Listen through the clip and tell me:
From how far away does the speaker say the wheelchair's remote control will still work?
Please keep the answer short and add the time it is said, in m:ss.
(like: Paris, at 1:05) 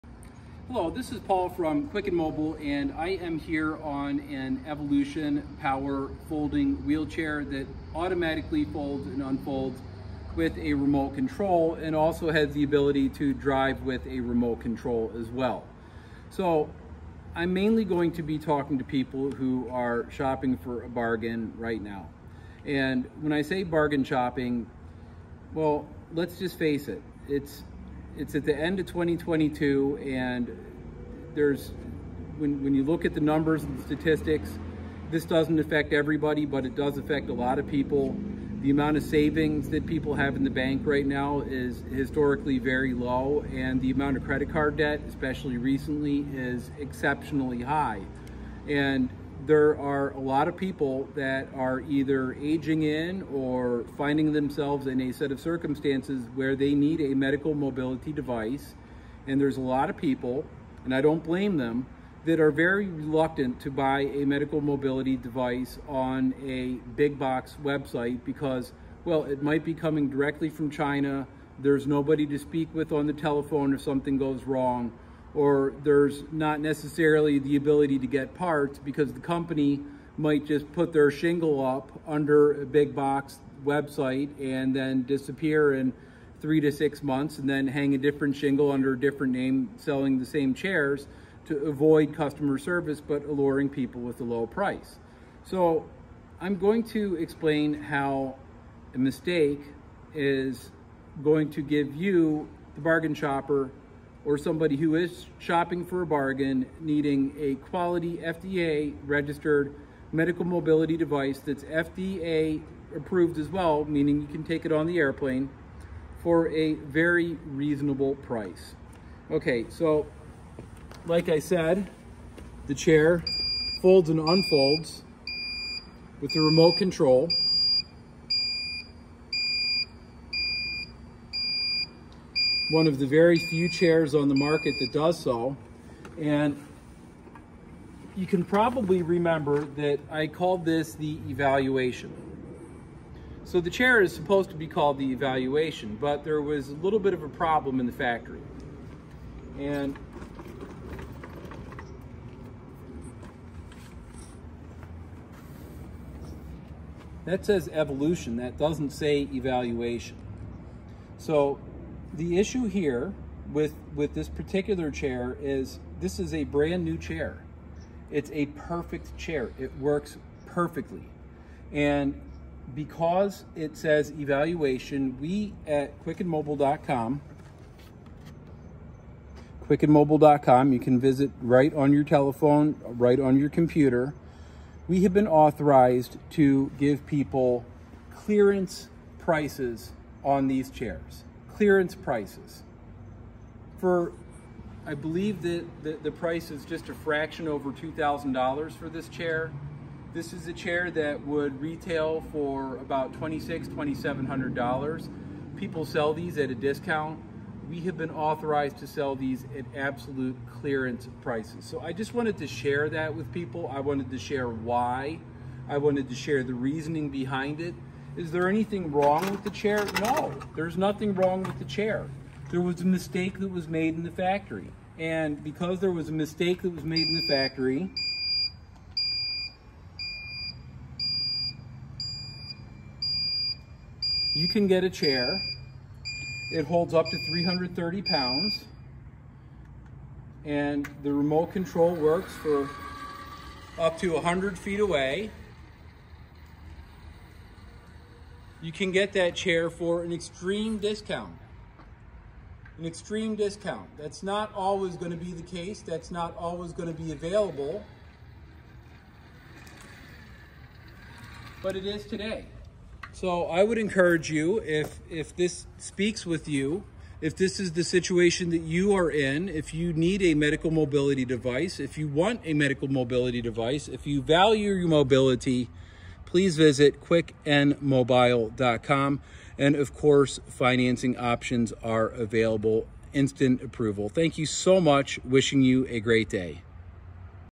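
100 feet, at 4:04.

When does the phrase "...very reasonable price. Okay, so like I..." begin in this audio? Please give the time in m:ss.
1:56.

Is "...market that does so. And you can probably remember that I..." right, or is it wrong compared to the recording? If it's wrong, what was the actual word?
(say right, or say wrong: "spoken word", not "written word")
right.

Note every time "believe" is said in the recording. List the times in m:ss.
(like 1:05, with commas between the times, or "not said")
3:14.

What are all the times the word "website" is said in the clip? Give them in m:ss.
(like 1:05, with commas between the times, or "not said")
1:07, 1:23.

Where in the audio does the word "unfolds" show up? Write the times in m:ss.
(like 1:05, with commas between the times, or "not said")
0:09, 2:04.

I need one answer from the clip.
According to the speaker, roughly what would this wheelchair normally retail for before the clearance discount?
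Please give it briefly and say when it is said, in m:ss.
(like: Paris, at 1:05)
$2,600-$2,700, at 3:23.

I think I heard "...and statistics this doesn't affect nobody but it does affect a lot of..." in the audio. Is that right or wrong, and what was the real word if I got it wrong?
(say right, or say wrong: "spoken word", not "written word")
wrong: "everybody", not "nobody".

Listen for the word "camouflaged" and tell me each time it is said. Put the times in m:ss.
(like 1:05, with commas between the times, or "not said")
not said.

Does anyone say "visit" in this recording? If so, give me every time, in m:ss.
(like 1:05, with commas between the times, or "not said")
3:00, 4:36.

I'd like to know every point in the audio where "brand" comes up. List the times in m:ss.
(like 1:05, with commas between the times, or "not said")
2:46.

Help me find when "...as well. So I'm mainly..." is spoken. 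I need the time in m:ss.
0:15.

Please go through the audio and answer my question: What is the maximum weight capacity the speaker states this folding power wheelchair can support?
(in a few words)
330 pounds.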